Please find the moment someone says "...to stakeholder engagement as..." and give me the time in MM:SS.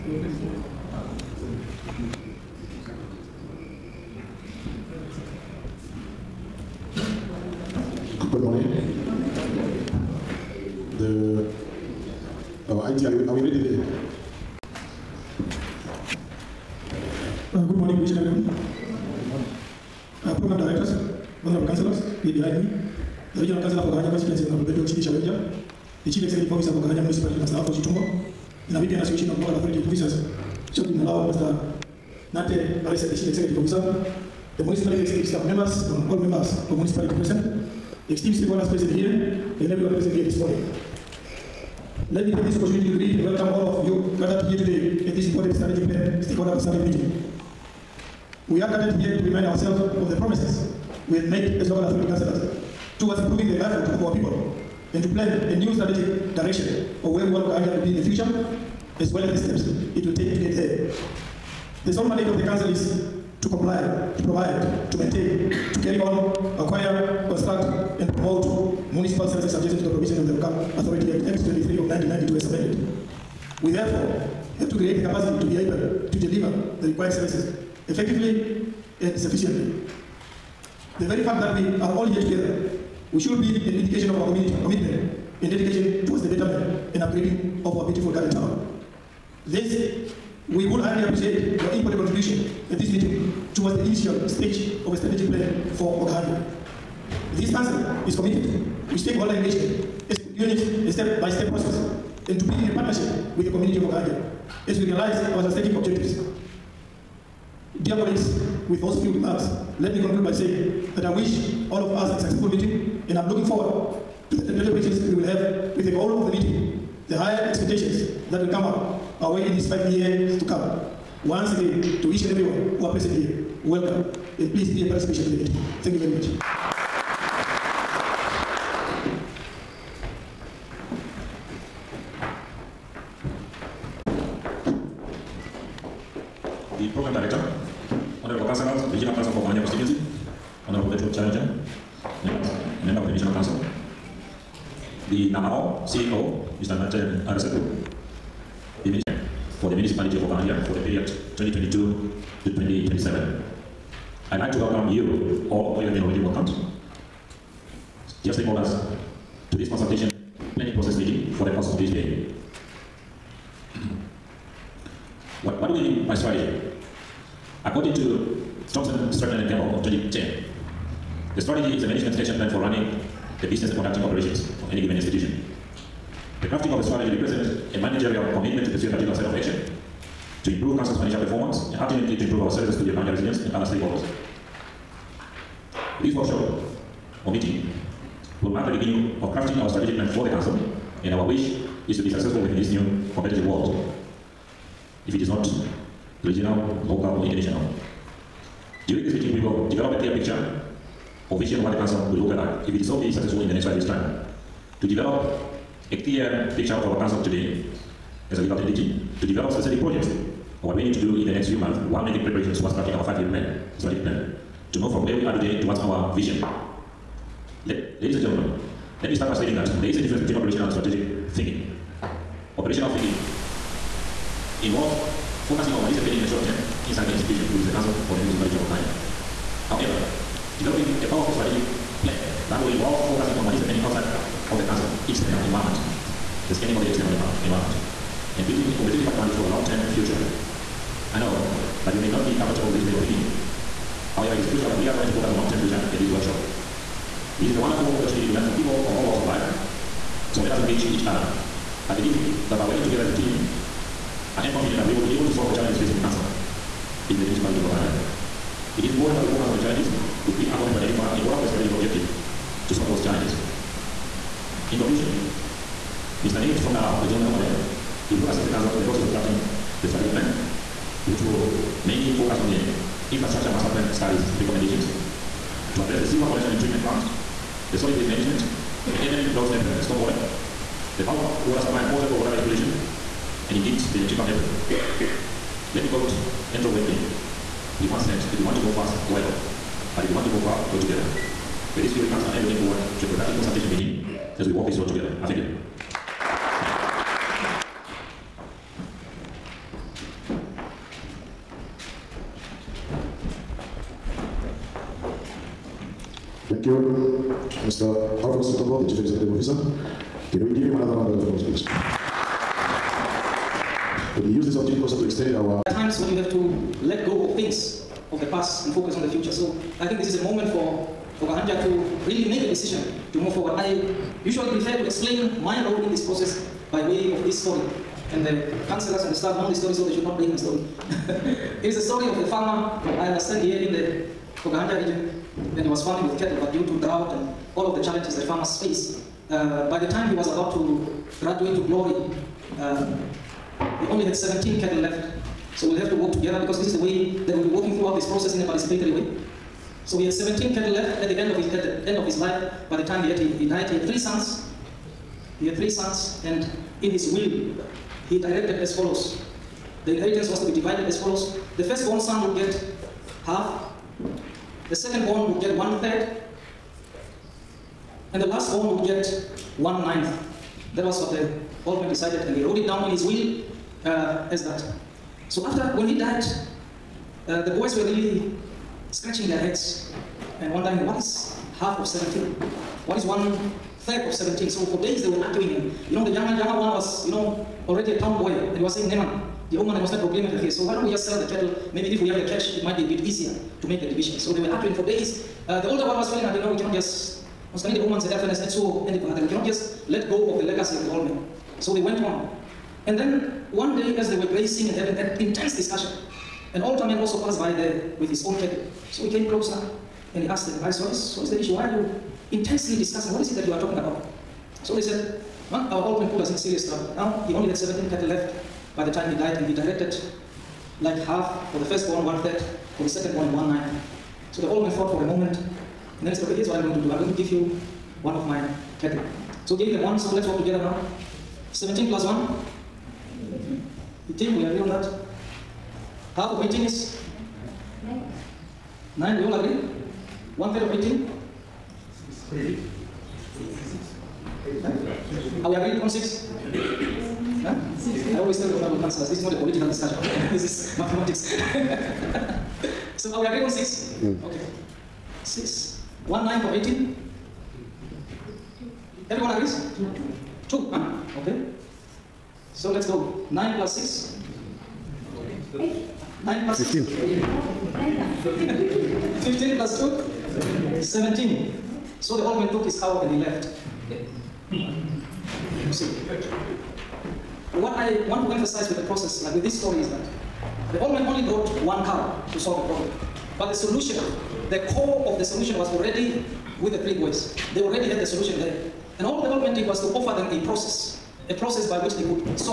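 01:38.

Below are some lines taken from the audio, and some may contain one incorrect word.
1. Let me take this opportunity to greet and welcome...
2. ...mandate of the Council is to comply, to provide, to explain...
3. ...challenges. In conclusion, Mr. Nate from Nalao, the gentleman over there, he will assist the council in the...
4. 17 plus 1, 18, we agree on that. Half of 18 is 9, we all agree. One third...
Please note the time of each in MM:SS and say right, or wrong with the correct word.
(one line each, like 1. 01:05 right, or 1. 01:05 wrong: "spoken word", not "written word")
1. 00:42 right
2. 01:02 wrong: "maintain", not "explain"
3. 04:23 right
4. 07:11 right.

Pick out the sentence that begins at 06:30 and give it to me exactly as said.
So why don't we just sell the cattle?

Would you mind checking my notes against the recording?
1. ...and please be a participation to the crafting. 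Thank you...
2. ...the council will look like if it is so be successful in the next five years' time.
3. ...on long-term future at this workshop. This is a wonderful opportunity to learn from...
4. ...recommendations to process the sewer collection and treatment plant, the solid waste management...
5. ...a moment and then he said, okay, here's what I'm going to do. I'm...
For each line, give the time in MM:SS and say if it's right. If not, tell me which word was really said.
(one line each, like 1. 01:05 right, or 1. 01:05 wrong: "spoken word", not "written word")
1. 02:04 wrong: "meeting", not "crafting"
2. 03:21 right
3. 04:05 right
4. 04:34 wrong: "address", not "process"
5. 07:05 right.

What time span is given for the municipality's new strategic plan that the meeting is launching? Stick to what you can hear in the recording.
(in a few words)
2022 to 2027.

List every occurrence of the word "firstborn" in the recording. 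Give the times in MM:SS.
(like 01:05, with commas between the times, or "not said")
06:01, 07:01.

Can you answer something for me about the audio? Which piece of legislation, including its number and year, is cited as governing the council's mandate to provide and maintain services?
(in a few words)
Local Authority Act, Act 23 of 1992.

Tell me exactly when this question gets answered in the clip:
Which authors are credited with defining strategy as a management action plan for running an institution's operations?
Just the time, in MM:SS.
02:48.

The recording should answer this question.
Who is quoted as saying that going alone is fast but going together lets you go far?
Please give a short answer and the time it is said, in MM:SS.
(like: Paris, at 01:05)
Andrew Whitby, at 04:46.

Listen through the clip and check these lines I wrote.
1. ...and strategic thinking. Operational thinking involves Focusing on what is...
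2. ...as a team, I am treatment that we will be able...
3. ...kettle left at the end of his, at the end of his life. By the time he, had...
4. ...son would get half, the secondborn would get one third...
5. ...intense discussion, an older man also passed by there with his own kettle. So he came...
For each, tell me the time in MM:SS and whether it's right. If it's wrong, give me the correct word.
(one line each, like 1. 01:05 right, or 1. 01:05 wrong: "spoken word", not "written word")
1. 03:40 right
2. 04:13 wrong: "confident", not "treatment"
3. 05:50 wrong: "cattle", not "kettle"
4. 06:01 right
5. 06:45 right.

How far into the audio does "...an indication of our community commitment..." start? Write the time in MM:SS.
01:23.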